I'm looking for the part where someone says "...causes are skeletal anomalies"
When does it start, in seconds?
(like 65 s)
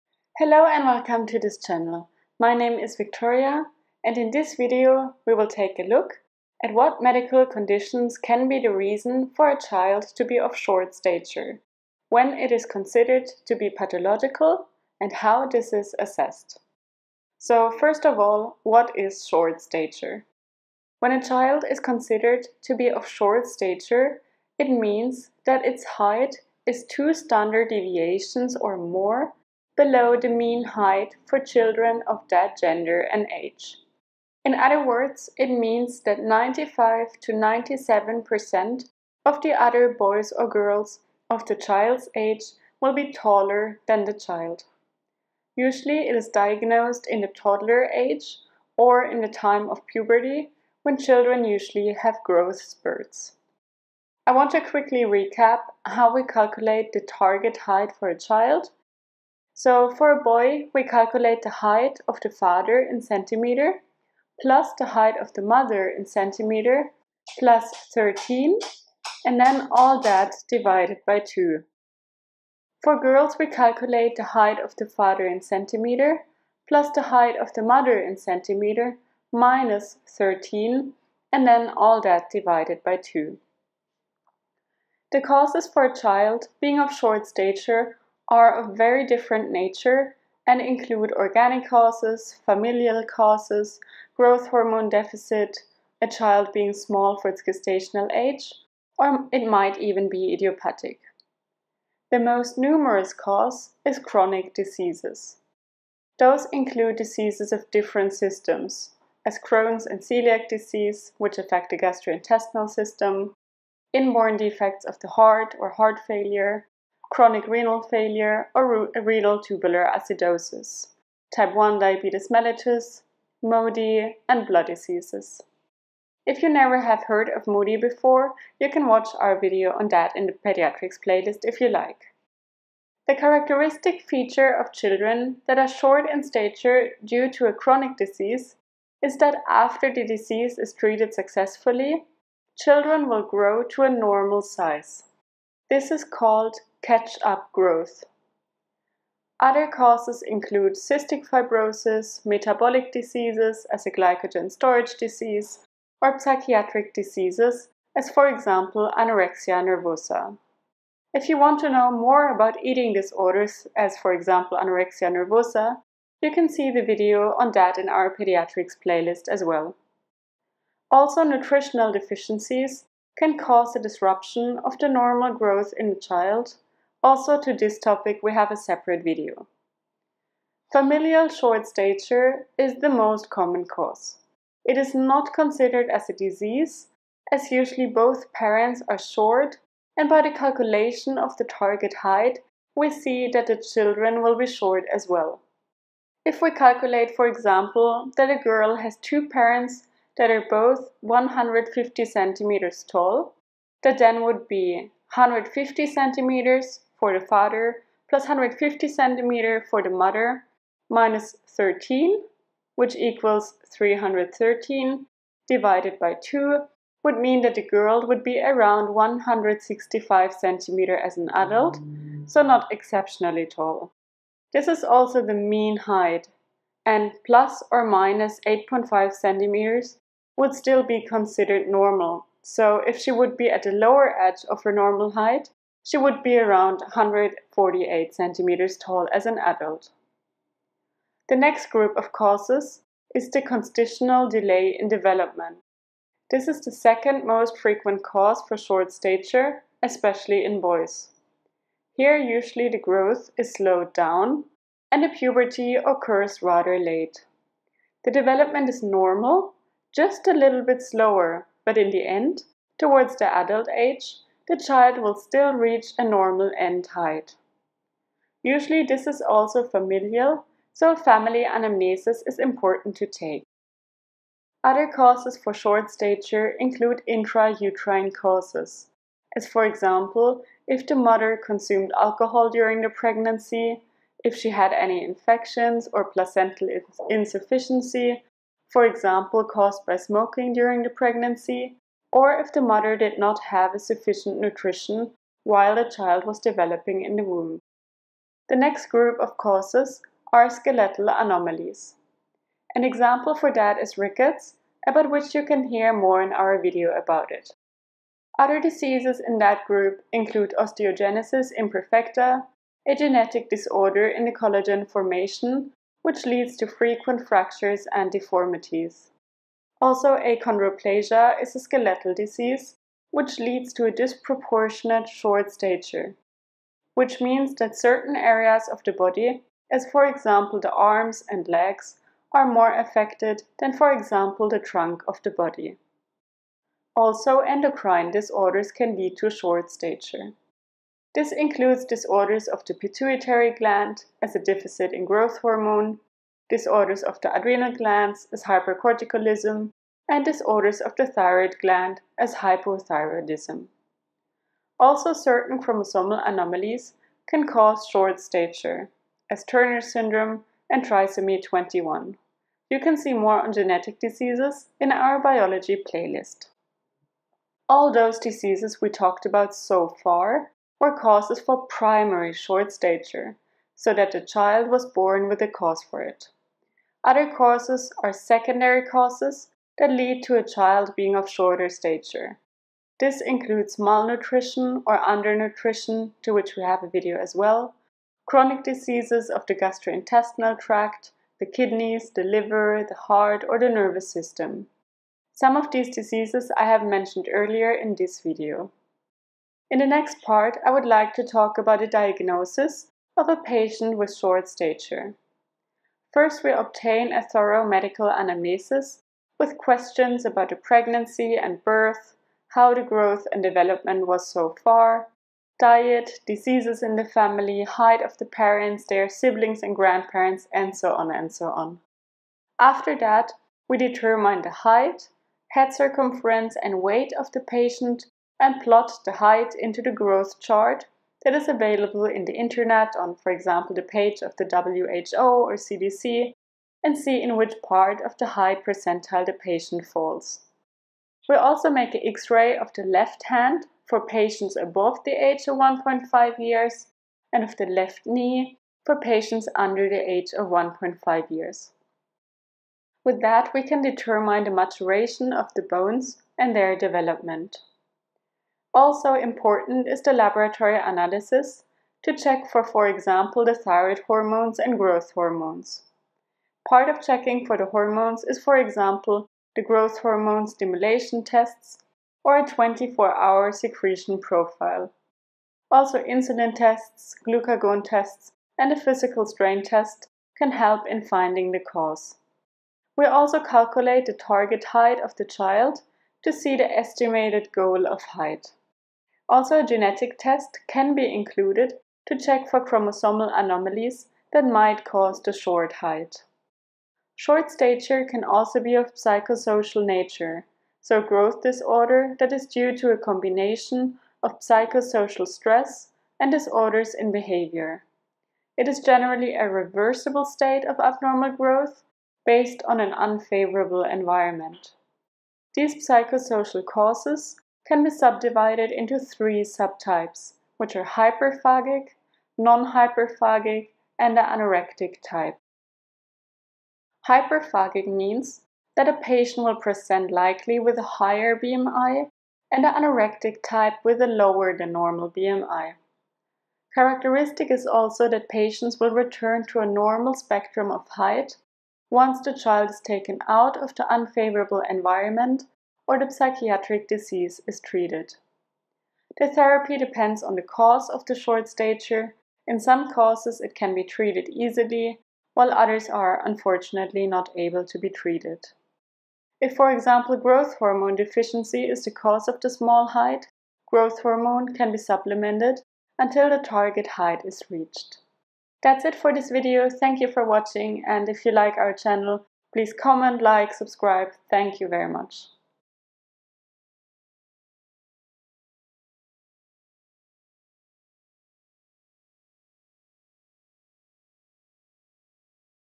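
299 s.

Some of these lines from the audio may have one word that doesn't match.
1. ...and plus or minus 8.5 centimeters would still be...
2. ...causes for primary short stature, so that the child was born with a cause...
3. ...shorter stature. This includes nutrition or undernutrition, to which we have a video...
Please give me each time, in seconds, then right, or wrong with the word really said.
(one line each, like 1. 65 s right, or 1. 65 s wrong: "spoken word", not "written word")
1. 226 s right
2. 370 s right
3. 381 s wrong: "malnutrition", not "nutrition".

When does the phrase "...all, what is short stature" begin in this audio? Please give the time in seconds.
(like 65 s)
18 s.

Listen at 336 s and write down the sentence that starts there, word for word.
Also, endocrine disorders can lead to short stature.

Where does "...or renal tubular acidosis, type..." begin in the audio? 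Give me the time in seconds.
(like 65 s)
118 s.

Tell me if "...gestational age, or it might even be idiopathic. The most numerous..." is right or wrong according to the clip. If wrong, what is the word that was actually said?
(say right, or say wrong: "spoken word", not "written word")
right.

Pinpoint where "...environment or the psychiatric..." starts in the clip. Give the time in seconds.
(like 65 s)
544 s.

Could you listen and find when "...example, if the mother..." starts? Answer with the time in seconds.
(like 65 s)
279 s.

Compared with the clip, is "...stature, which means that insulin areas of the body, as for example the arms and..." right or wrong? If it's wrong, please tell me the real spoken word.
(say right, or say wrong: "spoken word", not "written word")
wrong: "certain", not "insulin".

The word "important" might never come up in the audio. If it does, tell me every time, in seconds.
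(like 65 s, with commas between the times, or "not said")
272 s, 459 s.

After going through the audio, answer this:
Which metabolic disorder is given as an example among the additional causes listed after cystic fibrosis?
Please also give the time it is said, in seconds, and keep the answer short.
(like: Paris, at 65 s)
Glycogen storage disease, at 153 s.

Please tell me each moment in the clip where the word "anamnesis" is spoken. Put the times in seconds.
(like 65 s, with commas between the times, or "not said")
271 s, 408 s.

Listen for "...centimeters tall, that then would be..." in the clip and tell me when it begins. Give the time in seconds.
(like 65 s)
202 s.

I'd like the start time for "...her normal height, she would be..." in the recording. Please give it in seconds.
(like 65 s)
234 s.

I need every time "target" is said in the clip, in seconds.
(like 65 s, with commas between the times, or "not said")
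57 s, 191 s, 484 s, 566 s.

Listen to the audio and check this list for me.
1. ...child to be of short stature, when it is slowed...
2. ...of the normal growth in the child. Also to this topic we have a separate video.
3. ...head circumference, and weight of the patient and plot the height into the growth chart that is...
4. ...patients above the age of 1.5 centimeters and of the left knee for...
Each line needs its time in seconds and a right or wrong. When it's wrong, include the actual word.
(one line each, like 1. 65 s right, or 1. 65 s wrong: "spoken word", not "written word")
1. 9 s wrong: "considered", not "slowed"
2. 174 s right
3. 425 s right
4. 444 s wrong: "years", not "centimeters".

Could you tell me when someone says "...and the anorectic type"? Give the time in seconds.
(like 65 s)
523 s.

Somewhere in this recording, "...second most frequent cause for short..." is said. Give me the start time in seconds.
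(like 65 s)
246 s.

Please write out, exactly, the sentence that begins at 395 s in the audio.
Some of these diseases I have mentioned earlier in this video.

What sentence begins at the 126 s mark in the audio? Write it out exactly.
If you never have heard of MODY before, you can watch our video on that in the pediatrics playlist if you like.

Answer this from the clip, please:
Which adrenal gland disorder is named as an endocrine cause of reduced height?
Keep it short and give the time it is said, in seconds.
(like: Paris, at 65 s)
Hypercorticalism, at 348 s.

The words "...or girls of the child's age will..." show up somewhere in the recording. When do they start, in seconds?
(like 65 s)
40 s.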